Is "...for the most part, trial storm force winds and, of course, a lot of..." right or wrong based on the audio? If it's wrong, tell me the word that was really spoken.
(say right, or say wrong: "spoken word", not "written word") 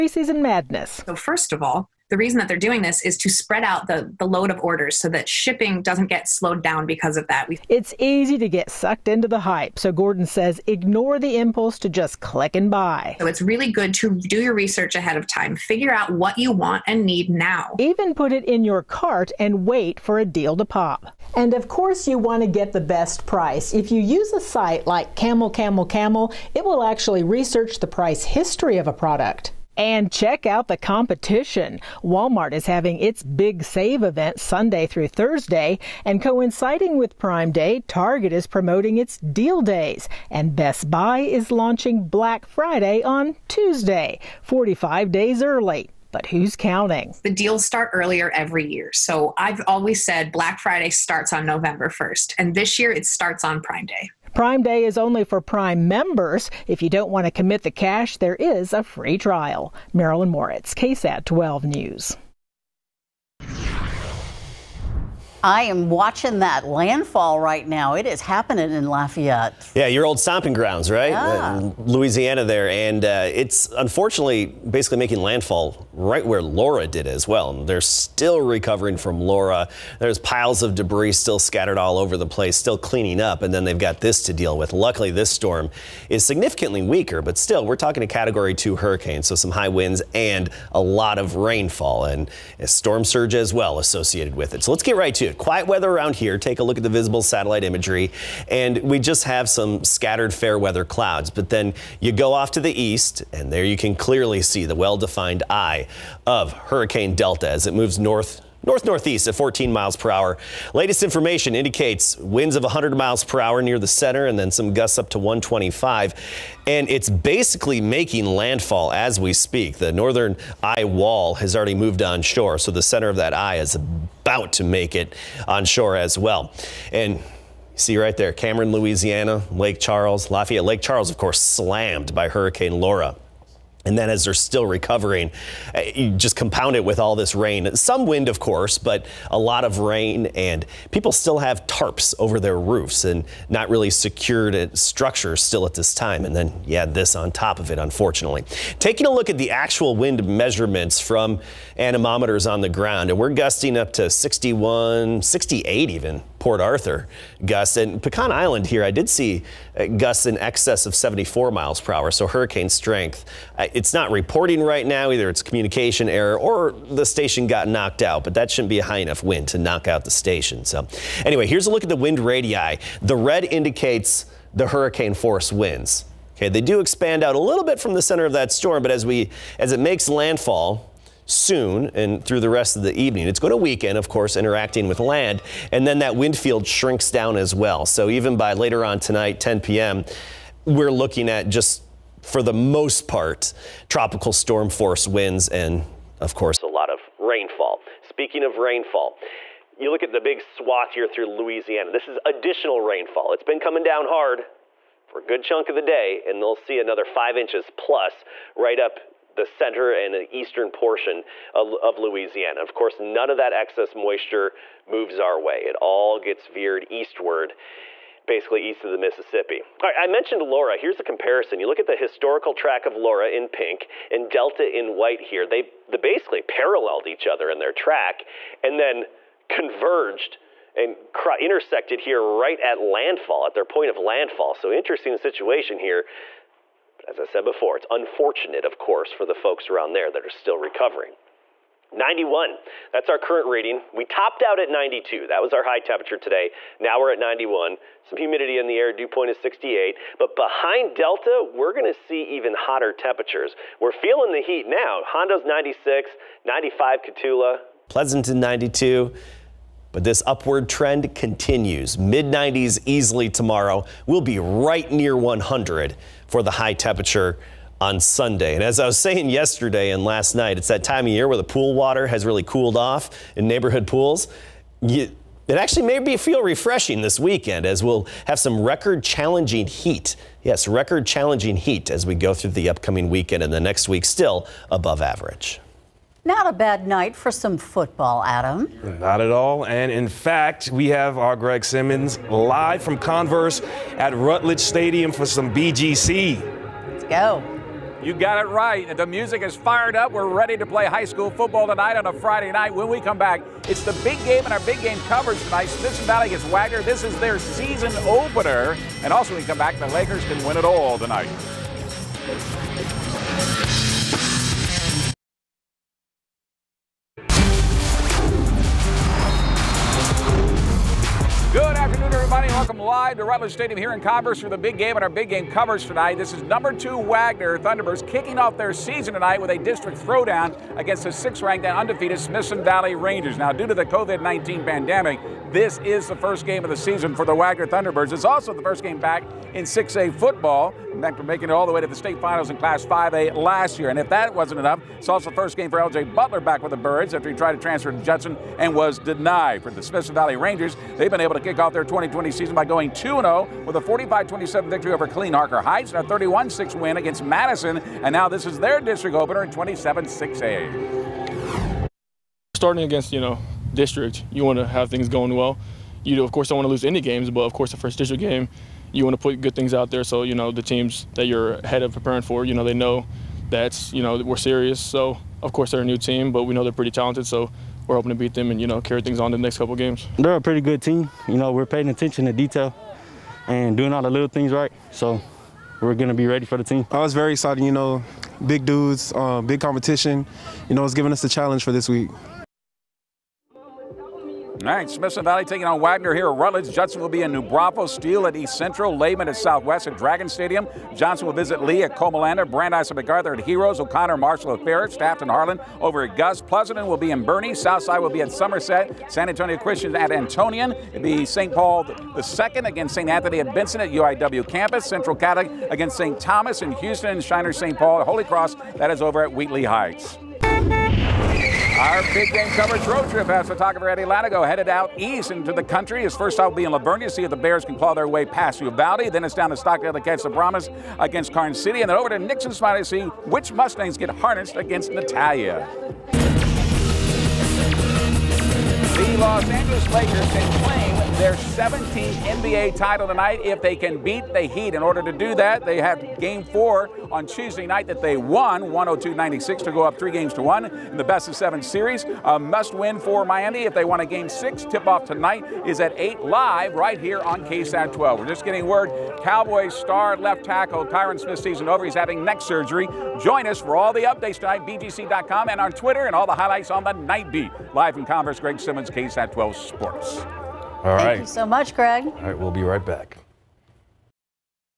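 wrong: "tropical", not "trial".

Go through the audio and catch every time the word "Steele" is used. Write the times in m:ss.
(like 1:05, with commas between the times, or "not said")
6:37.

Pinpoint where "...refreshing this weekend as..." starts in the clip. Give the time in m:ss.
4:36.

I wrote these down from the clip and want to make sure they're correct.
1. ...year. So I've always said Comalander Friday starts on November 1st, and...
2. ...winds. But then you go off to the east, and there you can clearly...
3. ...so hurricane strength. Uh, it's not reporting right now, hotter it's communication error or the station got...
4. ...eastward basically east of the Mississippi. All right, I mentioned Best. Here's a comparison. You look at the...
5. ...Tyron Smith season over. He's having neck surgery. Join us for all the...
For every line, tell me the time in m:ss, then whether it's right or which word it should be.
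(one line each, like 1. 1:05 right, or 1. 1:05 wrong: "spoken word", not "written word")
1. 0:48 wrong: "Black", not "Comalander"
2. 1:40 wrong: "clouds", not "winds"
3. 2:42 wrong: "either", not "hotter"
4. 3:36 wrong: "Laura", not "Best"
5. 7:40 right.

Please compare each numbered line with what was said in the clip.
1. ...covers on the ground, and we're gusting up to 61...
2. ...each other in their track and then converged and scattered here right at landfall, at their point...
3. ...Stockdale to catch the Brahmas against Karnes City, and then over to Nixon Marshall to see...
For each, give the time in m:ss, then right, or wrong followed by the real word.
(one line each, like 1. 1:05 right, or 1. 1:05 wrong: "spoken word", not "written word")
1. 2:31 wrong: "anemometers", not "covers"
2. 3:47 wrong: "intersected", not "scattered"
3. 7:09 wrong: "Spot", not "Marshall".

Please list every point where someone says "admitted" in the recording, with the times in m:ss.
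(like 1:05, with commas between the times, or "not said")
not said.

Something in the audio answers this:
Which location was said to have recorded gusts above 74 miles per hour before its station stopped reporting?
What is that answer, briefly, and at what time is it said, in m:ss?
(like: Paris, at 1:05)
Pecan Island, at 2:38.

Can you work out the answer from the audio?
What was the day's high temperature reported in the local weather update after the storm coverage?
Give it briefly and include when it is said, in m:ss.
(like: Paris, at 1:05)
92, at 4:03.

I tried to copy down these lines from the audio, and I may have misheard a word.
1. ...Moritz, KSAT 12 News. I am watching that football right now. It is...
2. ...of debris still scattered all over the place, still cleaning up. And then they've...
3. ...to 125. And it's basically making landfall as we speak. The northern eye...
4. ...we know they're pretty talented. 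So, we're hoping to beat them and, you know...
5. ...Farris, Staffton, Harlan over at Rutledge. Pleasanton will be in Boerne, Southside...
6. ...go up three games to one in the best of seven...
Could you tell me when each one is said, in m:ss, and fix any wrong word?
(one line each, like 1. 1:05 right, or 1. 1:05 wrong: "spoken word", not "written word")
1. 1:00 wrong: "landfall", not "football"
2. 1:20 right
3. 1:55 right
4. 6:16 right
5. 6:44 wrong: "Gus", not "Rutledge"
6. 7:29 right.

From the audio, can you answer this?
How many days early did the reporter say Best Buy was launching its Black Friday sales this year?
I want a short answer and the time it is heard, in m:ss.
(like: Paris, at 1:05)
45, at 0:44.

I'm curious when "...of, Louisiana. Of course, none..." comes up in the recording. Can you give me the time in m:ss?
3:31.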